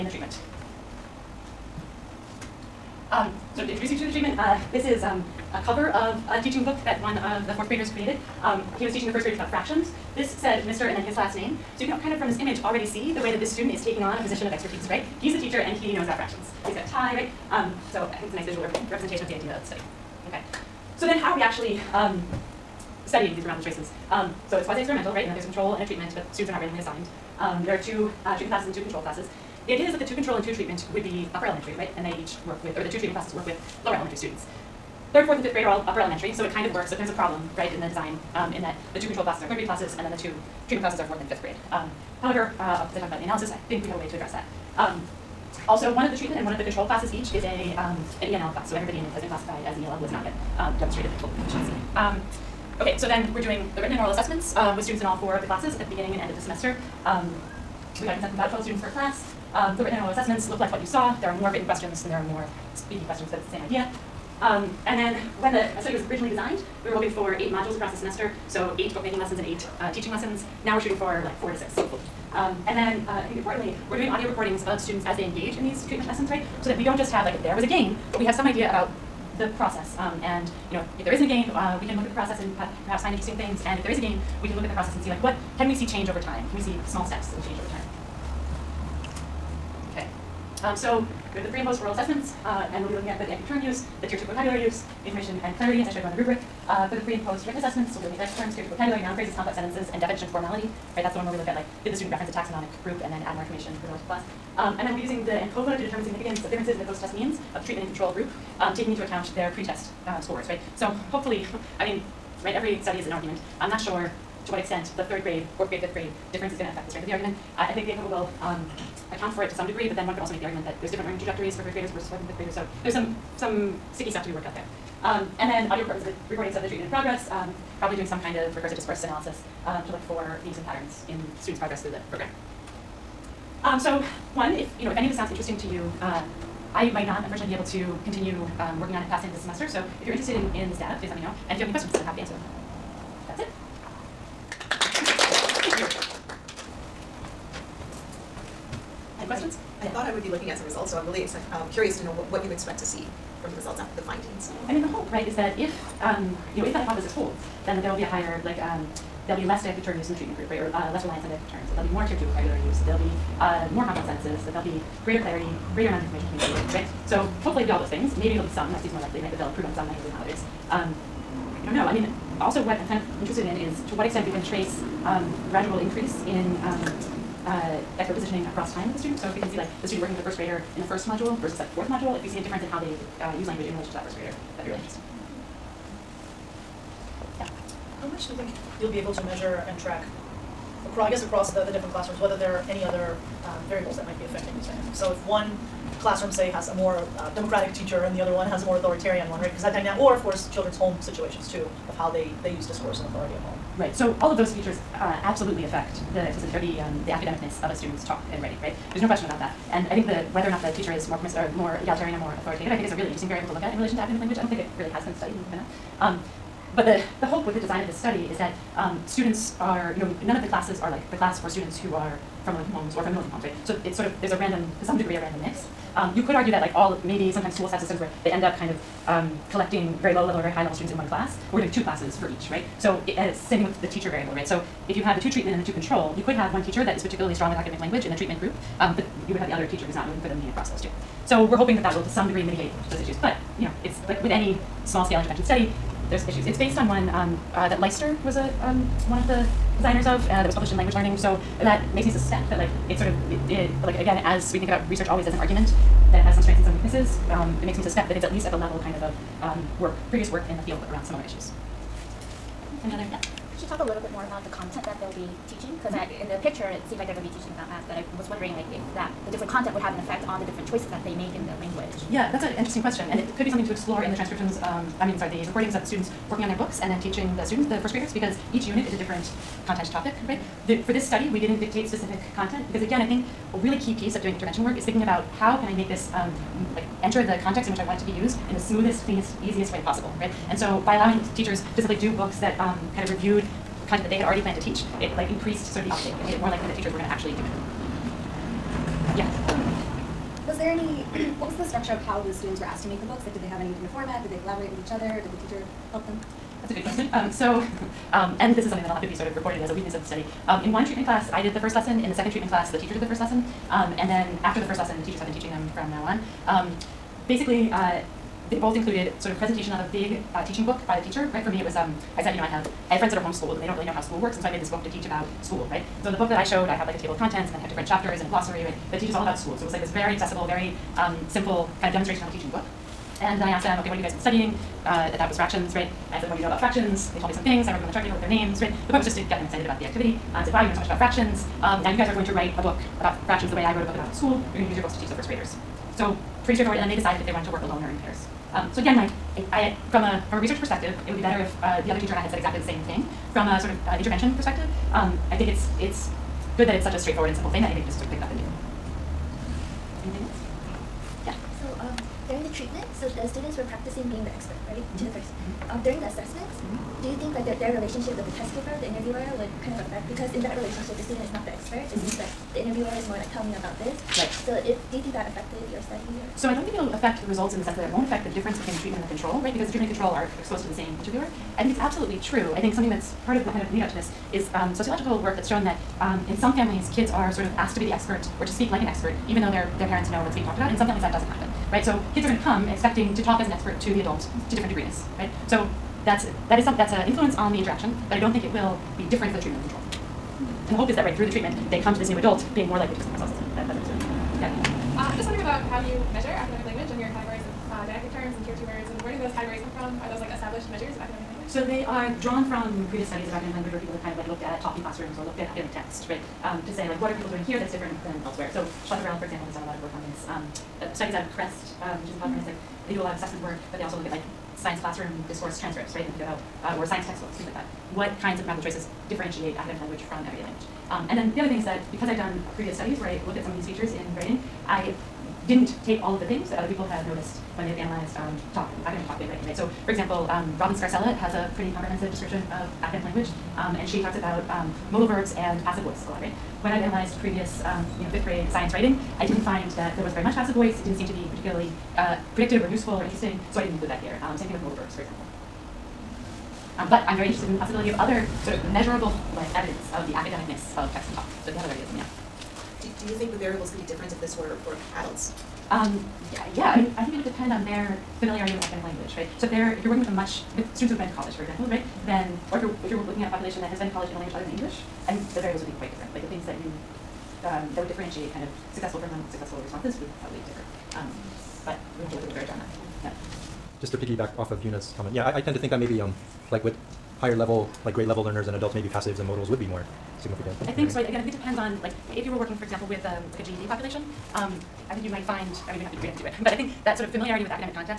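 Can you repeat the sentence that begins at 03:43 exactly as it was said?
So it's sort of, there's a random, to some degree, a random mix.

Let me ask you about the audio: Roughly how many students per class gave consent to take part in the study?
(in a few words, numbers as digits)
12.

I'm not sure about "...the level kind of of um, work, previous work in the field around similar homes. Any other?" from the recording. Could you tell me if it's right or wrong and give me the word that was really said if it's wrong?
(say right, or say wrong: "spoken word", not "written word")
wrong: "issues", not "homes".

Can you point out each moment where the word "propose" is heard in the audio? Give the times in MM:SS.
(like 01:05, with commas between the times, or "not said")
not said.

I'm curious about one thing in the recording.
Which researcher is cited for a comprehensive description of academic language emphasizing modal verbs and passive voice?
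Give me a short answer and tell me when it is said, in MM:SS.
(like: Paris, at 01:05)
Robin Scarcella, at 07:20.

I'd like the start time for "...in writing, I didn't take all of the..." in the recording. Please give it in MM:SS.
07:13.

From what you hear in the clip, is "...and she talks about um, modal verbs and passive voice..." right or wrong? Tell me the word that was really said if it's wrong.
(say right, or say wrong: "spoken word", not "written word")
right.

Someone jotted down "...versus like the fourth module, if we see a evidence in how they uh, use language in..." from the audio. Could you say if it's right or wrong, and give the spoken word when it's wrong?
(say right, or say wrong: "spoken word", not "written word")
wrong: "difference", not "evidence".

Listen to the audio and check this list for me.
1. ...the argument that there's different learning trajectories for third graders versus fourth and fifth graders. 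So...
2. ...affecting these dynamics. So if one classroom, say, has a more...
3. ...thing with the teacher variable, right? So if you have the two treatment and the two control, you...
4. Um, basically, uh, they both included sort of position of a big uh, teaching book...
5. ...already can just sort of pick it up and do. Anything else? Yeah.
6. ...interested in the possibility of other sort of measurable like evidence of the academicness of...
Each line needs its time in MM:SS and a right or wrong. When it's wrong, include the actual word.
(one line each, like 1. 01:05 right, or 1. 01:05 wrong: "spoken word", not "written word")
1. 02:00 right
2. 03:14 right
3. 03:53 right
4. 05:16 wrong: "presentation", not "position"
5. 05:57 wrong: "anybody", not "already"
6. 07:37 right.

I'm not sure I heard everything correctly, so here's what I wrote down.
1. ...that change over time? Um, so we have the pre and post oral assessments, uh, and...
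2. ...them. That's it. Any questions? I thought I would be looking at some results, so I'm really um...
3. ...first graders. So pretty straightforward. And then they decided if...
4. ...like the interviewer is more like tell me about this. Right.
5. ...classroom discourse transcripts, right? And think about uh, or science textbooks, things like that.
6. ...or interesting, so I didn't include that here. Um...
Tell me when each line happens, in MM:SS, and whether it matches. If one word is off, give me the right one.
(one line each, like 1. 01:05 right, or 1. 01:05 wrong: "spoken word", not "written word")
1. 01:27 right
2. 02:22 right
3. 05:45 right
4. 06:12 right
5. 07:04 right
6. 07:32 right.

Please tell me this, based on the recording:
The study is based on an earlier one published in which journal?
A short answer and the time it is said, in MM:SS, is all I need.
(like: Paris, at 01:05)
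Language Learning, at 04:10.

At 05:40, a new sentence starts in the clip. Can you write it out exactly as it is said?
Uh, I said, wow, you know so much about fractions.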